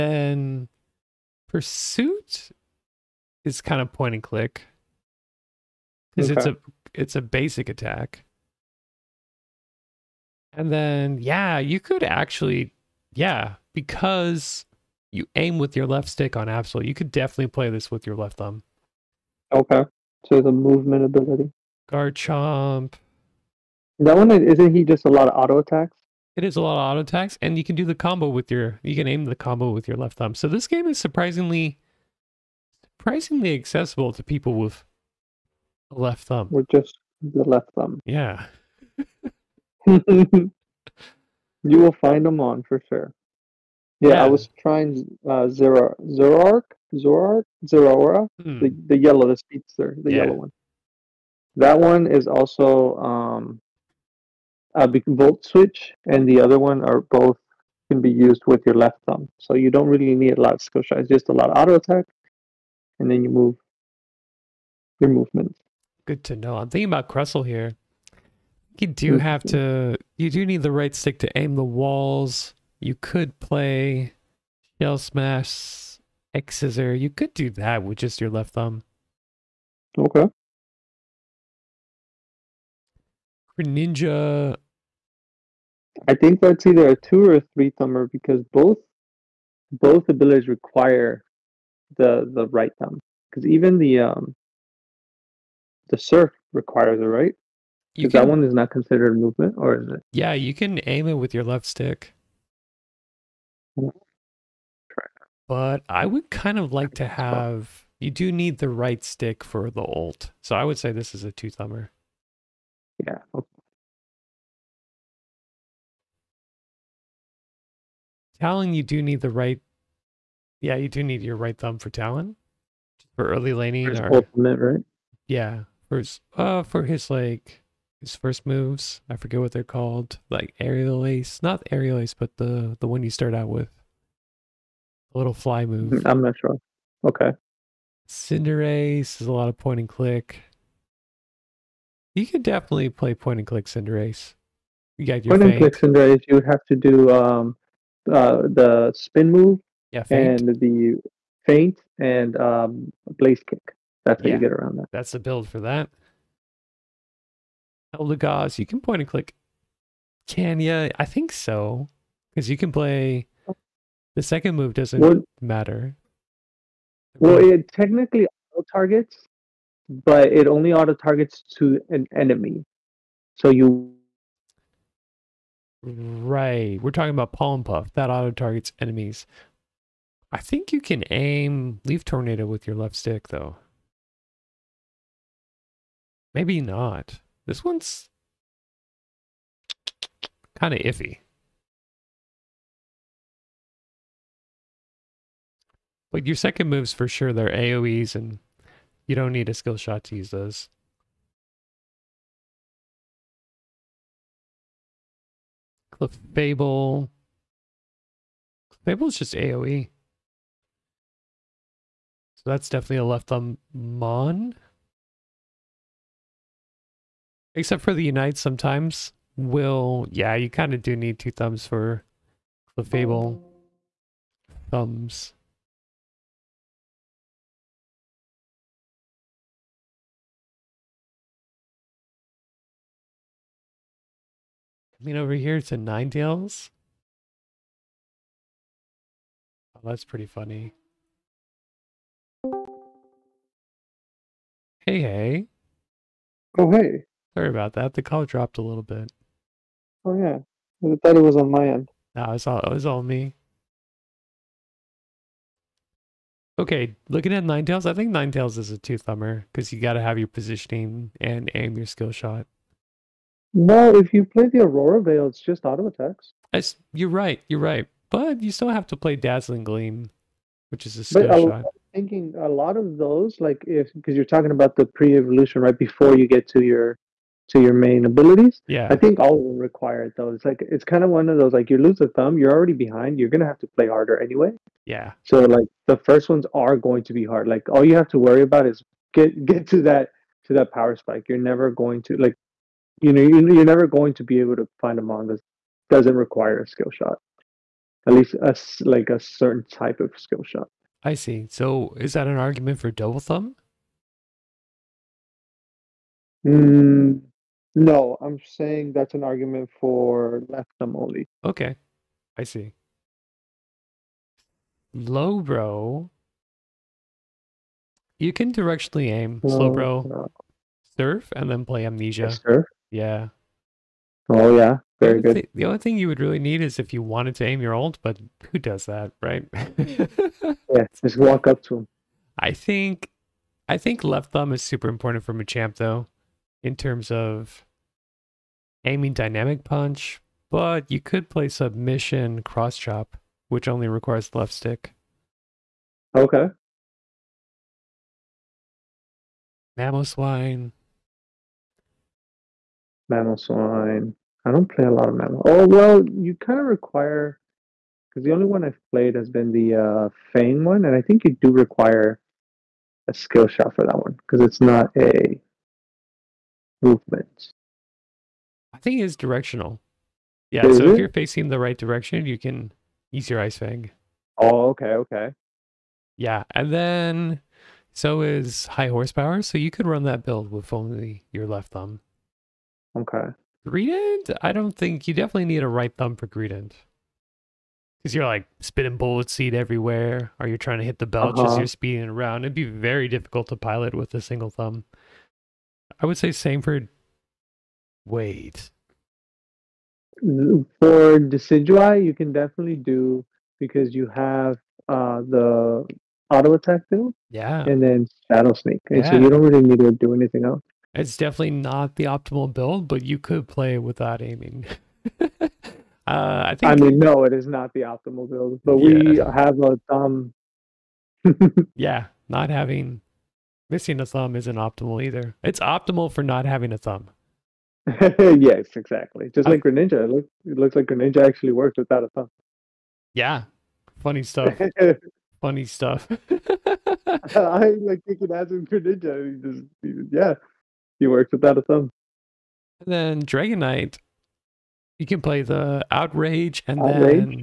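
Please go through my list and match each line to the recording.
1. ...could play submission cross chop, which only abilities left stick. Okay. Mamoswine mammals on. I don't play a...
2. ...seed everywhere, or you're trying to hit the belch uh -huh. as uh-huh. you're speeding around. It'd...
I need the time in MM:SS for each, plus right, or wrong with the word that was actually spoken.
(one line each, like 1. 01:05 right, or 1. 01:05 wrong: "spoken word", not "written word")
1. 05:40 wrong: "requires", not "abilities"
2. 06:29 right.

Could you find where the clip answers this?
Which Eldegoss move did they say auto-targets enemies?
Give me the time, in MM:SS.
02:57.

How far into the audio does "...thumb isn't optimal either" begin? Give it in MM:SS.
07:04.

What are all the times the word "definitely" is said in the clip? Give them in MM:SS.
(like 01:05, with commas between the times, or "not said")
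00:17, 02:22, 03:32, 06:25, 06:42, 06:51.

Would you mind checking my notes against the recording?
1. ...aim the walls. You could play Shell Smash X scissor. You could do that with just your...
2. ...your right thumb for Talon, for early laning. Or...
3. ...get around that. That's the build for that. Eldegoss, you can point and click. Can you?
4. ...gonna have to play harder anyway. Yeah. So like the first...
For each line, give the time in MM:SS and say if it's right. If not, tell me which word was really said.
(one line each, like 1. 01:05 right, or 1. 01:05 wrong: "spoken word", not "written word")
1. 01:11 right
2. 02:01 right
3. 02:34 right
4. 04:43 right.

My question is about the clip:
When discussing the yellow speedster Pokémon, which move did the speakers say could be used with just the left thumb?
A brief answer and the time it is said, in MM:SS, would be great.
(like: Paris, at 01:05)
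Volt Switch, at 00:55.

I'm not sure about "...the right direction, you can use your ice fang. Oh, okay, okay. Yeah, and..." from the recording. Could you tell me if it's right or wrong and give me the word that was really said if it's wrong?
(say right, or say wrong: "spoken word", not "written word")
right.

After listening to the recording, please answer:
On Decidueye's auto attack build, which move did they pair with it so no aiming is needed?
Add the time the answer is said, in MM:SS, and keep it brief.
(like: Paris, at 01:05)
Shadow Sneak, at 06:48.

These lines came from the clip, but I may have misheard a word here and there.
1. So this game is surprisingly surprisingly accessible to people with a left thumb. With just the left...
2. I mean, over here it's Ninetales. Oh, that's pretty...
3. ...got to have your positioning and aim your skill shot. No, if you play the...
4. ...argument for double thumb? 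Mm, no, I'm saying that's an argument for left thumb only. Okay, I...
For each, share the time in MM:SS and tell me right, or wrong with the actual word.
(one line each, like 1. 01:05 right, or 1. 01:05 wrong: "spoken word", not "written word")
1. 00:30 right
2. 03:55 right
3. 04:19 right
4. 05:02 right.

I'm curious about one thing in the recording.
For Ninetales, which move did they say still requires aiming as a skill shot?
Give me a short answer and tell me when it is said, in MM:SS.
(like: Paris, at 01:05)
Dazzling Gleam, at 04:29.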